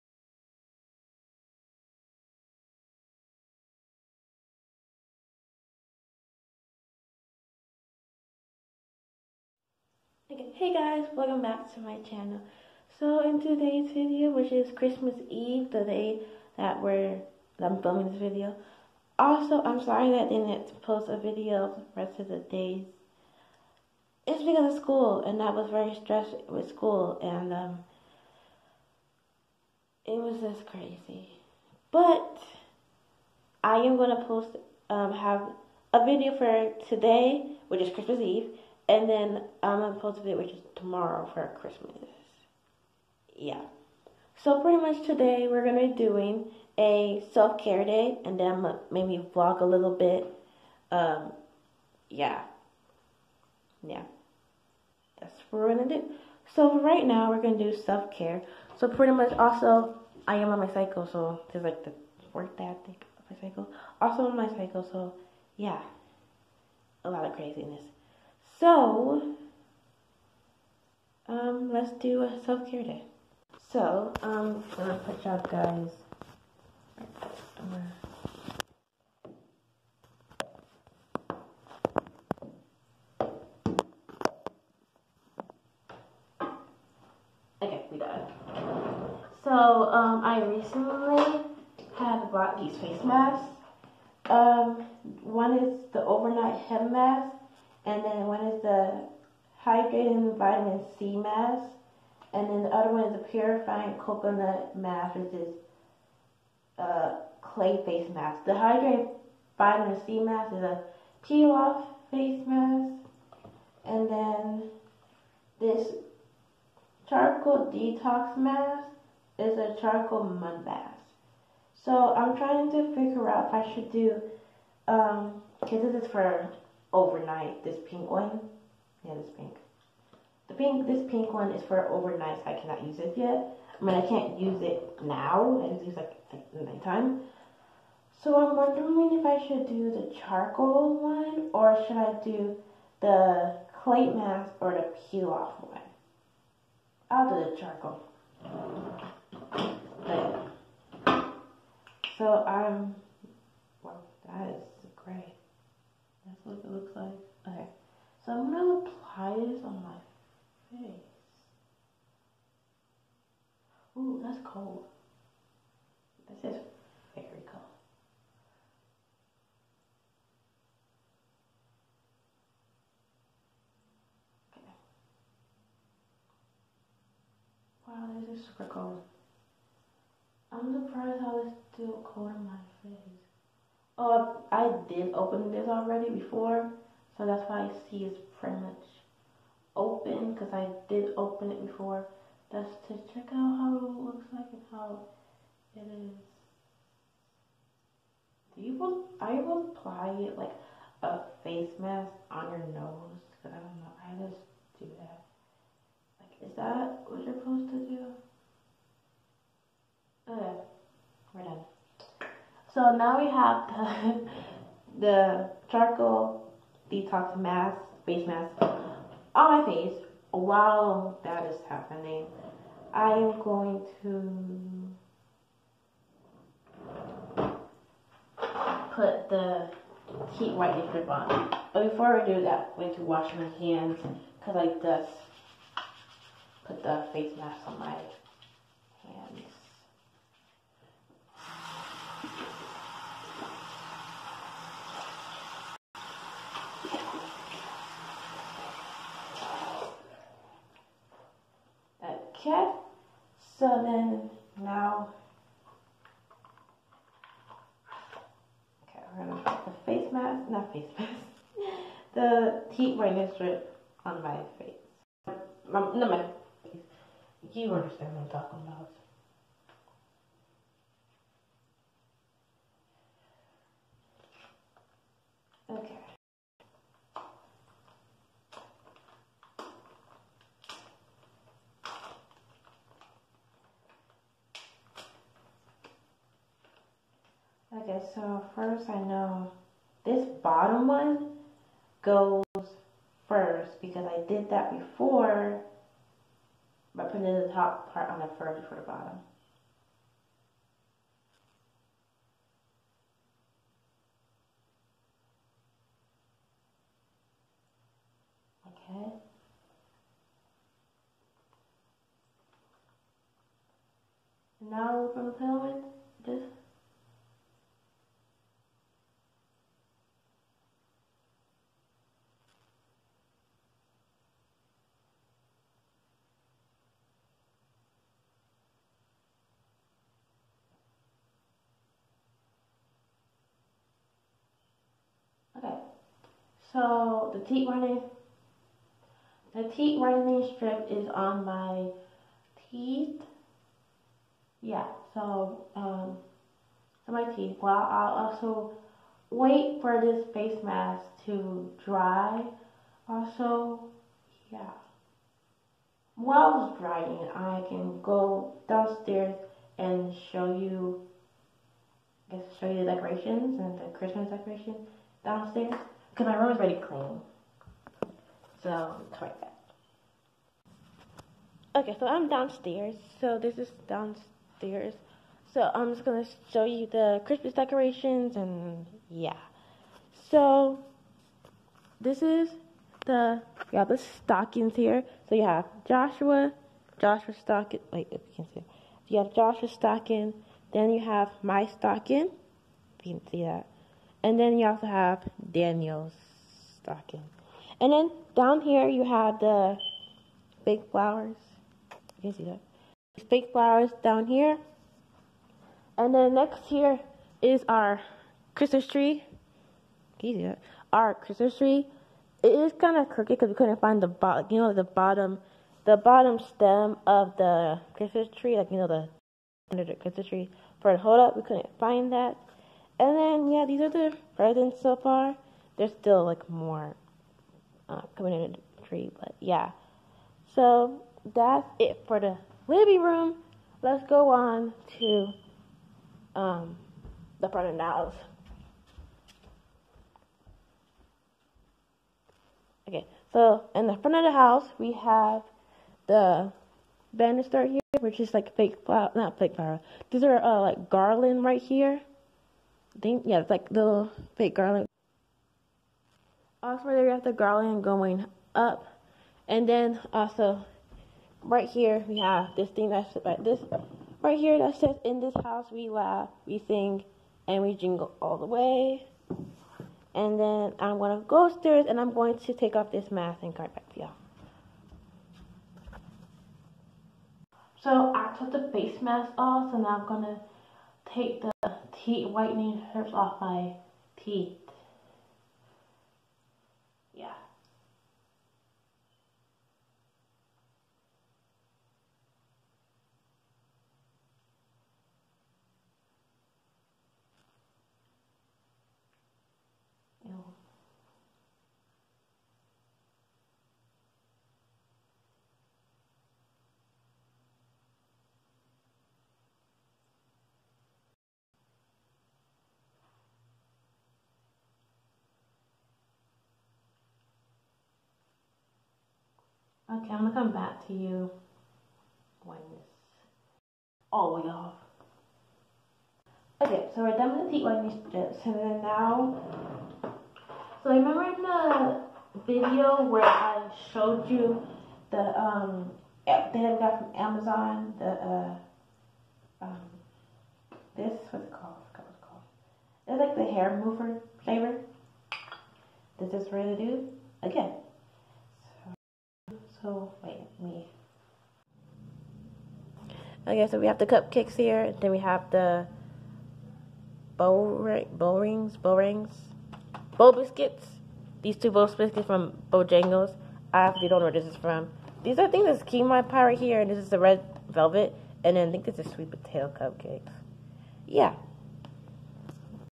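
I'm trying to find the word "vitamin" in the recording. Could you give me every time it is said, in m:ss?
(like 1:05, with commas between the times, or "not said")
1:40, 1:49.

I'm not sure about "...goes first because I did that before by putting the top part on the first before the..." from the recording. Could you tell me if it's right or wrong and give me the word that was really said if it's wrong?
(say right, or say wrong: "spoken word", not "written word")
right.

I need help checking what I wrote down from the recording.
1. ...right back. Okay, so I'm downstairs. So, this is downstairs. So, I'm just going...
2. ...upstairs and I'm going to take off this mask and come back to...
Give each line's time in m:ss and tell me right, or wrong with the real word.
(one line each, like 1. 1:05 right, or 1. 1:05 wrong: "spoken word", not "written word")
1. 6:09 right
2. 7:51 right.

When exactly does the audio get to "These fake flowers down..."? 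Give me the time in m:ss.
6:43.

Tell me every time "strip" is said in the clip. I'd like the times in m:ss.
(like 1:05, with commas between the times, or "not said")
3:50, 4:23, 5:40, 8:48.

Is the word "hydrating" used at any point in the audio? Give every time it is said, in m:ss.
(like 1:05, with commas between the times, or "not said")
1:39, 1:48.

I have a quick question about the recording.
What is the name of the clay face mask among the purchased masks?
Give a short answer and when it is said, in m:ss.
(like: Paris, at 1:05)
purifying coconut mask, at 1:43.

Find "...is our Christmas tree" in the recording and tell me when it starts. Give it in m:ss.
6:47.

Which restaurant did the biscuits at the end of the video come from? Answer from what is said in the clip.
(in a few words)
Bojangles.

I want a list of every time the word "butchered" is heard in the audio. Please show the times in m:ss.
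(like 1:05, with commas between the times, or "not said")
not said.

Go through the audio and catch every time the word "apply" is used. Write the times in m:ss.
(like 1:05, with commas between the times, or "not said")
2:38, 3:19.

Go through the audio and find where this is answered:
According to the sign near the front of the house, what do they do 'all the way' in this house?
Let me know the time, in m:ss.
7:47.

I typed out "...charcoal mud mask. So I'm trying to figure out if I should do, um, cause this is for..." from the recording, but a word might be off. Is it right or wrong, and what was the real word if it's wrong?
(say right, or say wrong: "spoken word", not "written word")
right.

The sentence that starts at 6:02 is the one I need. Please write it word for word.
I guess show you the decorations and the Christmas decoration downstairs.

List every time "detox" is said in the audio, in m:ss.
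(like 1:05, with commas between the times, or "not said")
1:57, 3:36.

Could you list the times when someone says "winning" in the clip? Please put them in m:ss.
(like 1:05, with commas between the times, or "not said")
not said.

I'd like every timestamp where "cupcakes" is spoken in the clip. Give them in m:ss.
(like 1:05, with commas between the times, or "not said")
9:14, 9:29.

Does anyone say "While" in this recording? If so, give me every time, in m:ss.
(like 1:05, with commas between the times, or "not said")
3:40, 5:56.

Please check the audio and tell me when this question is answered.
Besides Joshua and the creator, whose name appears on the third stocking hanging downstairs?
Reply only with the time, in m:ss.
6:35.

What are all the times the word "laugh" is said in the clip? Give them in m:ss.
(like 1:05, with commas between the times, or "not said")
7:45.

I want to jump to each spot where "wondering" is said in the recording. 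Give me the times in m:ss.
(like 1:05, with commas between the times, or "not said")
2:18.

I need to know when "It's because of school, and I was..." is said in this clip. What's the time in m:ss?
0:24.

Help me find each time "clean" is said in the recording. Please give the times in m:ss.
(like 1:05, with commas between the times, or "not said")
6:06.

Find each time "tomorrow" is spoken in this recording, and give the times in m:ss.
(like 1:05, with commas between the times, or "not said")
0:40.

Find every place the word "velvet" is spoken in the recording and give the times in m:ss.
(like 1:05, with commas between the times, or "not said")
9:27.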